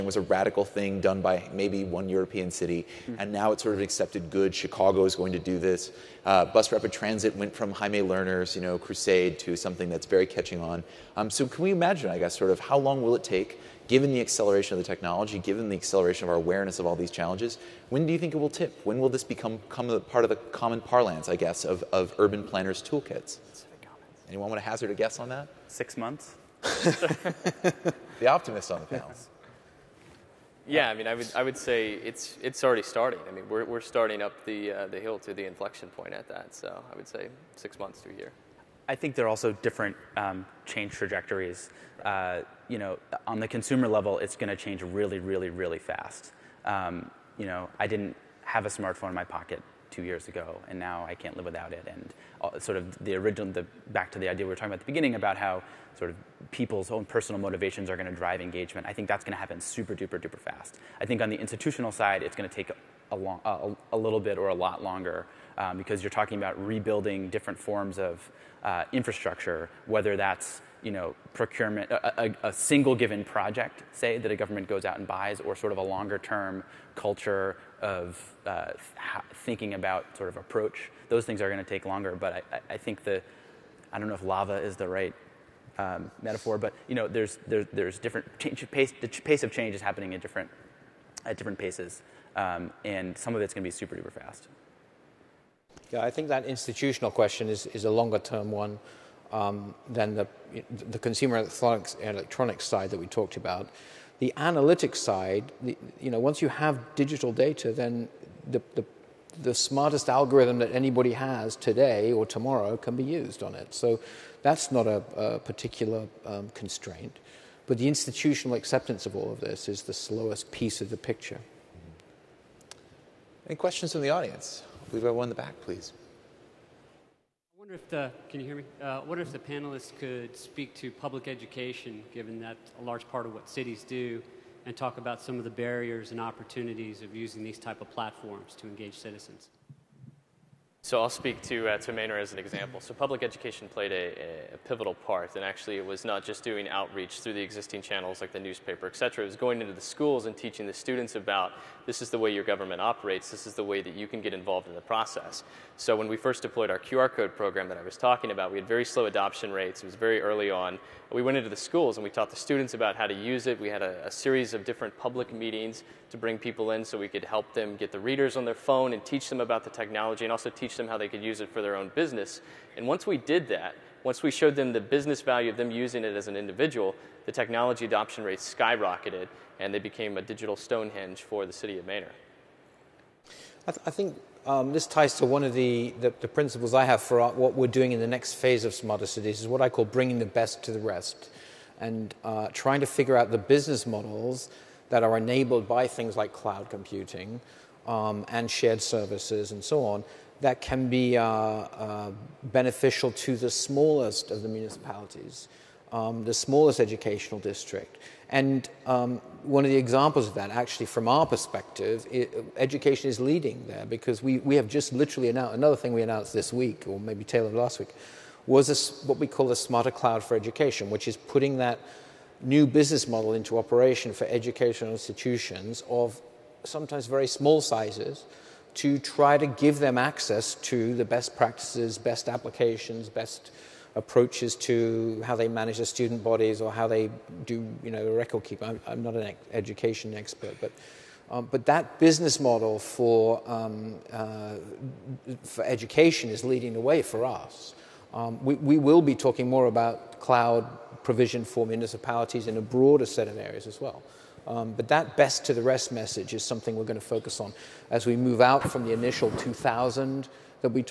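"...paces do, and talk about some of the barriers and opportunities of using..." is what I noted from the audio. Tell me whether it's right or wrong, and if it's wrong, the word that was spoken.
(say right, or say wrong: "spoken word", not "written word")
wrong: "cities", not "paces".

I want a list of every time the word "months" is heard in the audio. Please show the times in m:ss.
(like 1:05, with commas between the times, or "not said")
0:25, 0:37.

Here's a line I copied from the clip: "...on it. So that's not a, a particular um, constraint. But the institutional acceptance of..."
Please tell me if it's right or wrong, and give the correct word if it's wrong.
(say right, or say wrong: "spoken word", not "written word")
right.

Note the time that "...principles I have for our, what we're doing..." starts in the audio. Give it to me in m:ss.
3:06.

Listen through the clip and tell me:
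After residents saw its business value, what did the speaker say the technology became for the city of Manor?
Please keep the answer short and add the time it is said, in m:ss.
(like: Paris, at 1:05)
digital Stonehenge, at 3:00.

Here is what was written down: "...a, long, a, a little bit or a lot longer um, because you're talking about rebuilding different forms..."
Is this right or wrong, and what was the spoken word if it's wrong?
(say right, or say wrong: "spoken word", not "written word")
right.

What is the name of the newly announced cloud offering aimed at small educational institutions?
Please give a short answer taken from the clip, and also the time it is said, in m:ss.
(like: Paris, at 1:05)
Smarter Cloud for Education, at 3:39.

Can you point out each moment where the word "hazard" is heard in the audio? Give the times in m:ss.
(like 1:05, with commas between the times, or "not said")
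0:24.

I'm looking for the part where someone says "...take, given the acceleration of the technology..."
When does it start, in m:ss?
0:13.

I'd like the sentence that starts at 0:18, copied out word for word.
When will this become, become part of the common parlance, I guess, of, of urban planners' toolkits?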